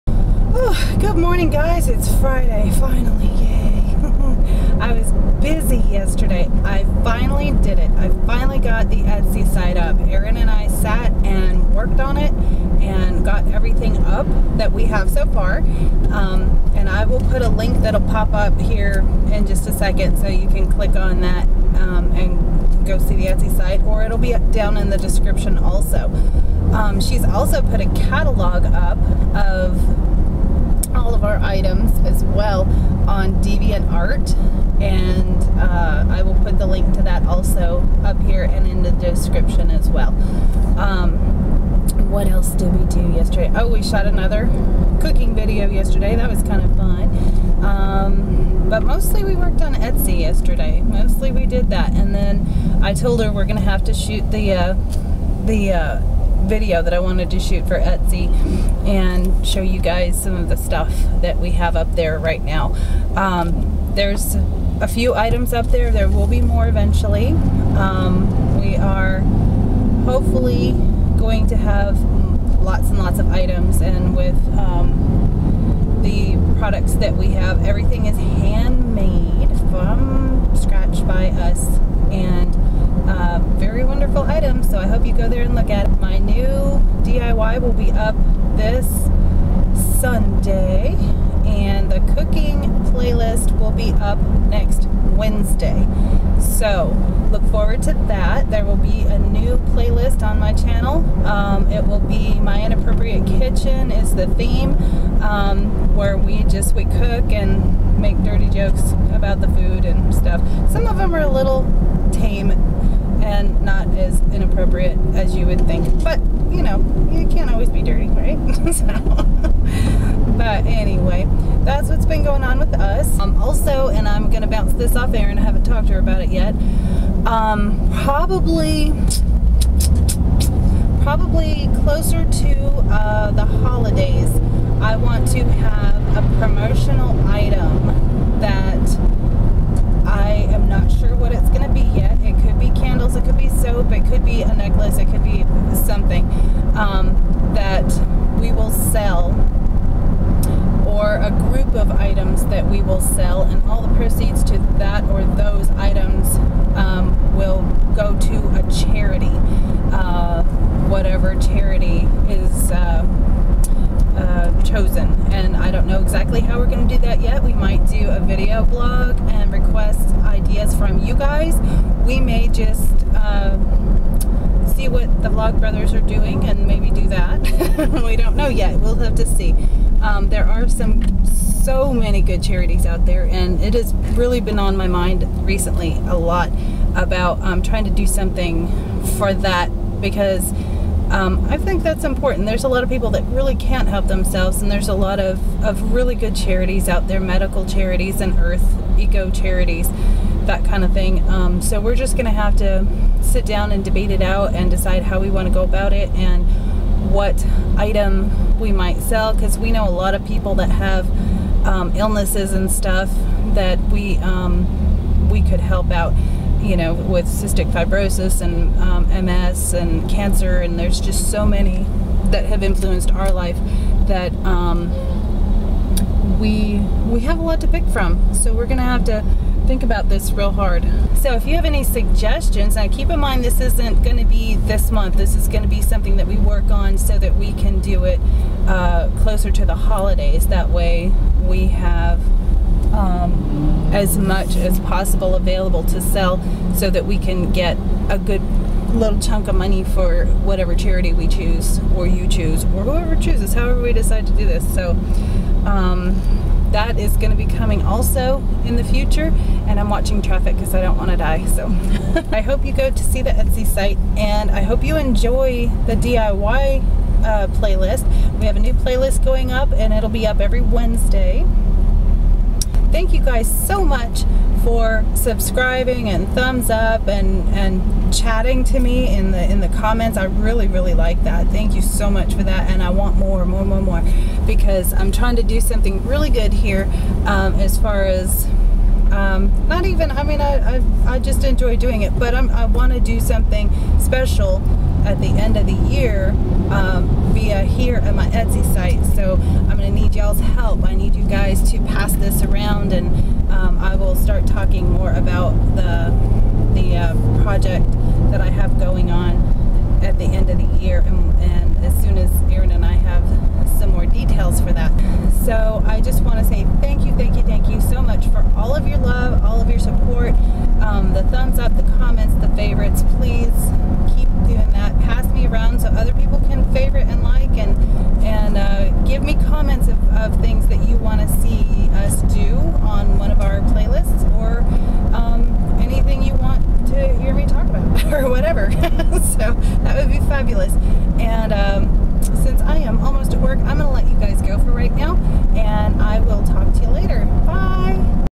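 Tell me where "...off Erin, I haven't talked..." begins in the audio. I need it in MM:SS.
02:04.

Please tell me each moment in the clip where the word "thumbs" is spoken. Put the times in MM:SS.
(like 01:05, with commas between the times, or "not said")
04:36, 05:21.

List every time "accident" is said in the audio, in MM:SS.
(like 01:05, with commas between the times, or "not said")
not said.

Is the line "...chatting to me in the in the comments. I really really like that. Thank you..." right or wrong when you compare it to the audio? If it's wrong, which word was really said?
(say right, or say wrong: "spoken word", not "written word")
right.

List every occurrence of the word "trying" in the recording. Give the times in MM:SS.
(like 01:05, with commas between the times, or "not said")
03:07, 04:45.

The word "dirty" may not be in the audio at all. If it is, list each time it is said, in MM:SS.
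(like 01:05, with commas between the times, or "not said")
01:48, 01:57.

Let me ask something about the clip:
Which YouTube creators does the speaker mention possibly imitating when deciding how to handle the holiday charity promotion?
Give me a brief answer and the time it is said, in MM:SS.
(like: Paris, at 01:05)
Vlogbrothers, at 02:55.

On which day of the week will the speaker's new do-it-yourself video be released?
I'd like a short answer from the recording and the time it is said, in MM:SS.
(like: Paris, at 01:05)
Sunday, at 01:29.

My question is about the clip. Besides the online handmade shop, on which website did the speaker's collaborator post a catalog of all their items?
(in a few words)
DeviantArt.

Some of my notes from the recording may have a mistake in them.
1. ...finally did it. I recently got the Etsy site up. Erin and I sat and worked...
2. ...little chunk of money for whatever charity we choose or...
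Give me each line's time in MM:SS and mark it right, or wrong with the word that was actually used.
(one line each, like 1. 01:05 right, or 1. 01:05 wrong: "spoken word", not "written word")
1. 00:07 wrong: "finally", not "recently"
2. 04:08 right.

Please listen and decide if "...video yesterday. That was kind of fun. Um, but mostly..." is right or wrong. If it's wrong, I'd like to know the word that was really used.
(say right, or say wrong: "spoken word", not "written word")
right.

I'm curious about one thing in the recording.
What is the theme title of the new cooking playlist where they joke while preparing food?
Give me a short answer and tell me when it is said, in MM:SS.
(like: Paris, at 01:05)
My Inappropriate Kitchen, at 01:42.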